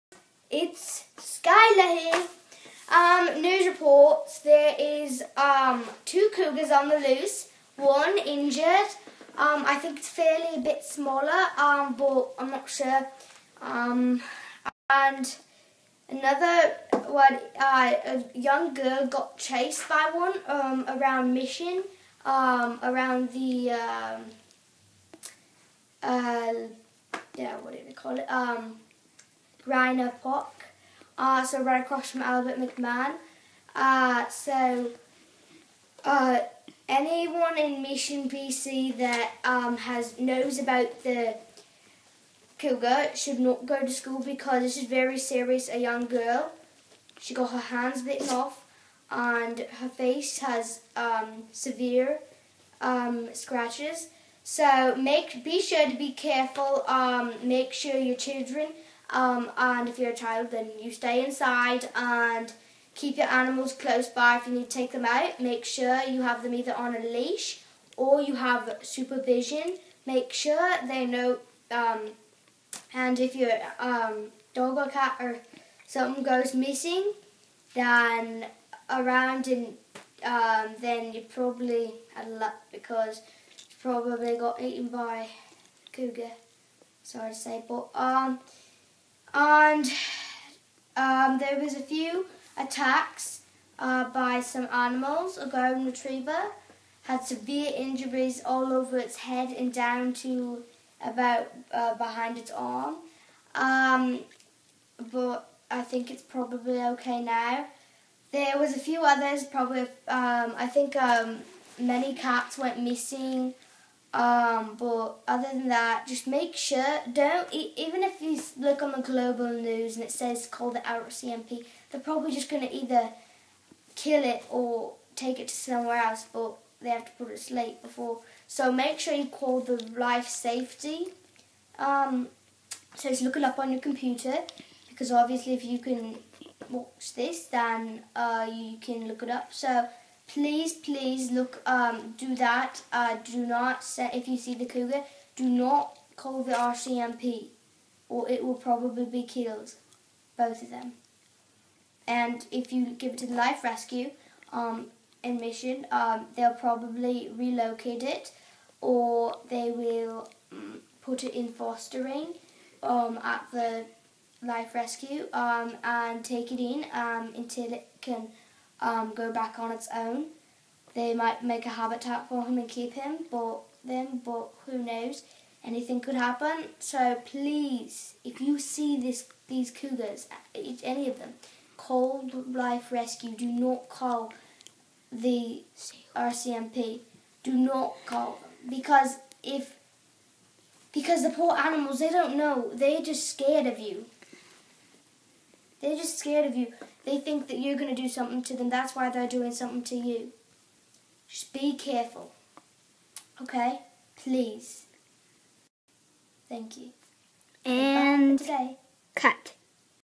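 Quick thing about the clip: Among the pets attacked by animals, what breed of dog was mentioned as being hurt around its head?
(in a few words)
golden retriever.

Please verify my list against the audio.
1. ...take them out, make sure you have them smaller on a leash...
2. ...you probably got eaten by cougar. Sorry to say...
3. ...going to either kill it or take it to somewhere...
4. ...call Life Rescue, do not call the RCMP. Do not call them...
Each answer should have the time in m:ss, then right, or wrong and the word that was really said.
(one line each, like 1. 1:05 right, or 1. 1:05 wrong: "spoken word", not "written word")
1. 1:04 wrong: "either", not "smaller"
2. 1:23 right
3. 2:02 right
4. 3:01 right.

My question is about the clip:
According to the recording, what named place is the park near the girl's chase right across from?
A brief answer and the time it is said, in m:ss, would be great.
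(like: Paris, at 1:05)
Albert McMahon, at 0:32.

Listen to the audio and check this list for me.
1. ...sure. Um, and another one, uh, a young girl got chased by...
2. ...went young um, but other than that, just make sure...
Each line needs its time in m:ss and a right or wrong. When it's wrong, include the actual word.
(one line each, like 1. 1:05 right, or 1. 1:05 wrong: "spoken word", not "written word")
1. 0:12 right
2. 1:52 wrong: "missing", not "young".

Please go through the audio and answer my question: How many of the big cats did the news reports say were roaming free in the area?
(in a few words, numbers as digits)
2.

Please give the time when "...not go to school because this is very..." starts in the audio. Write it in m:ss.
0:43.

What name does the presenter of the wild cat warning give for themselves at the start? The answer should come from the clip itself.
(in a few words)
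Skylar.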